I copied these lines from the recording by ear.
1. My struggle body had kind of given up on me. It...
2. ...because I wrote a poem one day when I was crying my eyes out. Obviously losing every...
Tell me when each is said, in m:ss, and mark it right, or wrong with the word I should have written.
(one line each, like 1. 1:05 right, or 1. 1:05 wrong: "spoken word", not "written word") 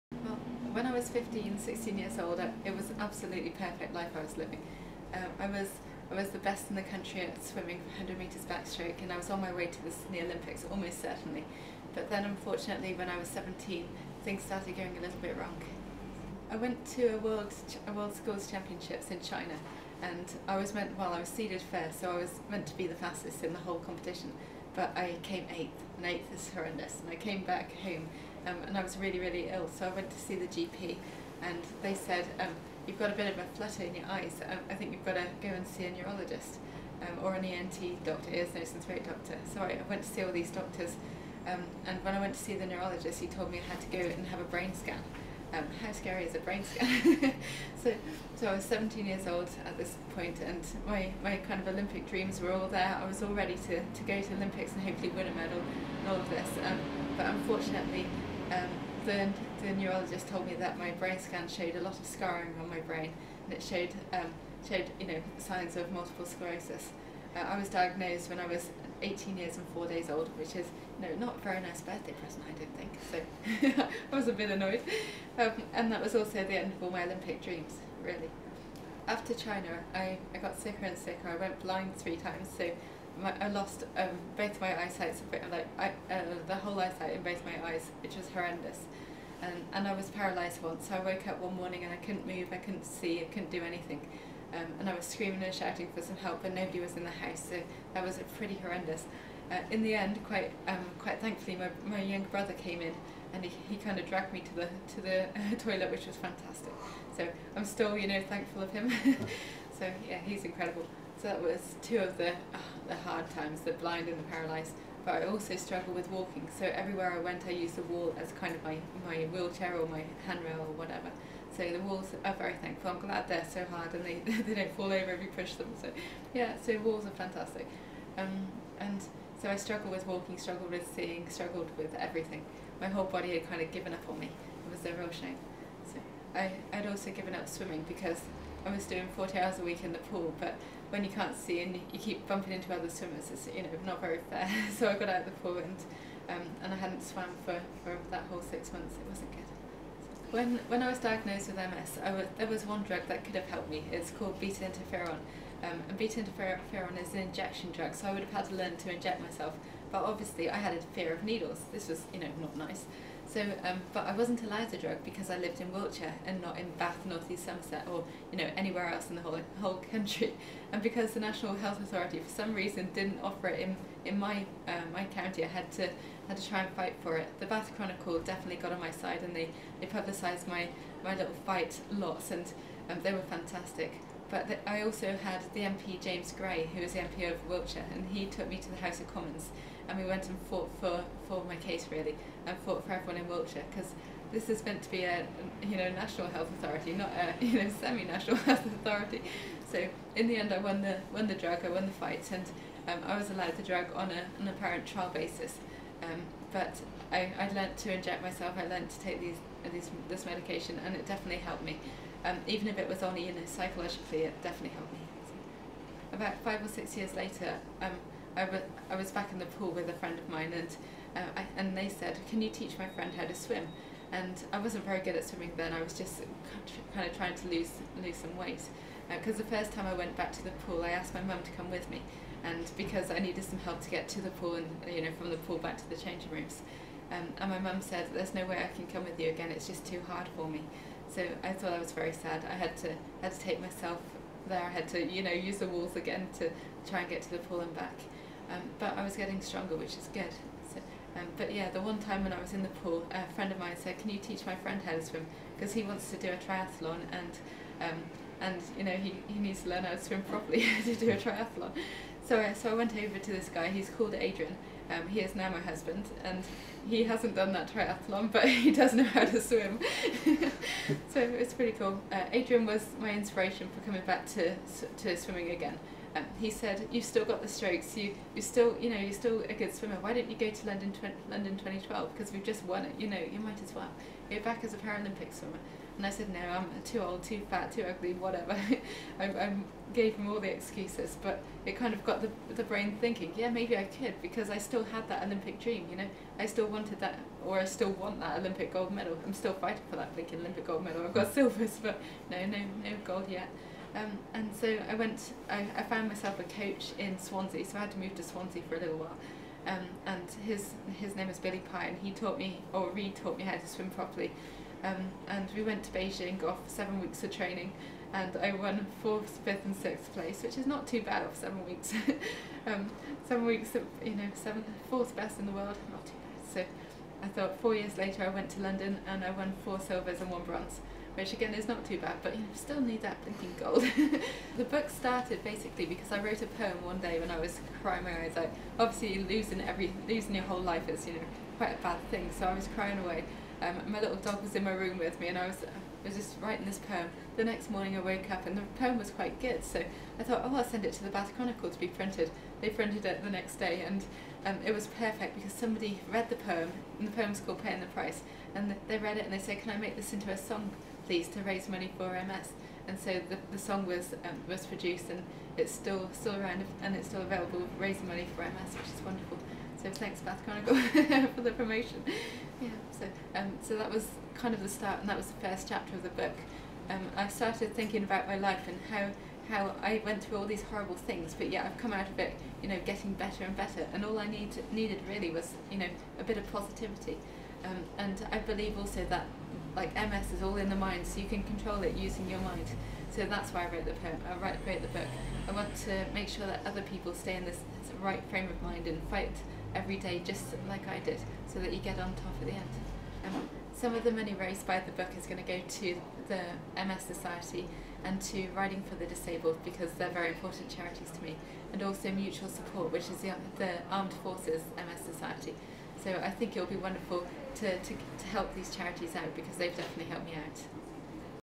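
1. 2:12 wrong: "whole", not "struggle"
2. 5:35 right.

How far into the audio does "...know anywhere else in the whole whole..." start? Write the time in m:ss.
2:48.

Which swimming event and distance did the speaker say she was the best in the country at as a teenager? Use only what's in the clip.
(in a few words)
100 metres backstroke.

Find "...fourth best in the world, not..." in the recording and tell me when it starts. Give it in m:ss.
5:24.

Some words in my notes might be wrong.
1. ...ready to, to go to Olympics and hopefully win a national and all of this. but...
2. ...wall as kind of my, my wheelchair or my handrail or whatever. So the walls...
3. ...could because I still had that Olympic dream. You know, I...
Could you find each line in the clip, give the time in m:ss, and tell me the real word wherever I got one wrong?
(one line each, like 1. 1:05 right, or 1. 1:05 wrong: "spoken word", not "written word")
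1. 0:53 wrong: "medal", not "national"
2. 1:57 right
3. 4:53 right.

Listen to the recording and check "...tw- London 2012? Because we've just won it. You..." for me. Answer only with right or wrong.
right.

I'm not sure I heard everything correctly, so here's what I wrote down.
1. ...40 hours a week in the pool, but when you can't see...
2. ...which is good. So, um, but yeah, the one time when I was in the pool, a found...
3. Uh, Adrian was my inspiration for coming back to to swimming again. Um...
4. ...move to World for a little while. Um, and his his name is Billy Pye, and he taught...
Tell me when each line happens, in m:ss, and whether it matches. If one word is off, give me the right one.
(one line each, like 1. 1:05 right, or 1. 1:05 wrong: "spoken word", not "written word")
1. 2:19 right
2. 4:09 wrong: "friend", not "found"
3. 4:32 right
4. 5:07 wrong: "Swansea", not "World".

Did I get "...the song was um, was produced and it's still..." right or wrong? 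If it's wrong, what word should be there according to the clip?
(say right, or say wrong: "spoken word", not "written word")
right.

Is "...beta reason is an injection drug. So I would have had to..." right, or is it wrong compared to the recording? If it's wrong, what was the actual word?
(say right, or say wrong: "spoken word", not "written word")
wrong: "interferon", not "reason".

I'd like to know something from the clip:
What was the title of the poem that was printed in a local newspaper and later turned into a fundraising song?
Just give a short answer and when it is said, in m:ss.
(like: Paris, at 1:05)
Paying the Price, at 5:57.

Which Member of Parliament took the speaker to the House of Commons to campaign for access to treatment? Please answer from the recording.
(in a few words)
James Gray.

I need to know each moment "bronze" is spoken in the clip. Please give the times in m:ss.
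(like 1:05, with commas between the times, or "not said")
5:30.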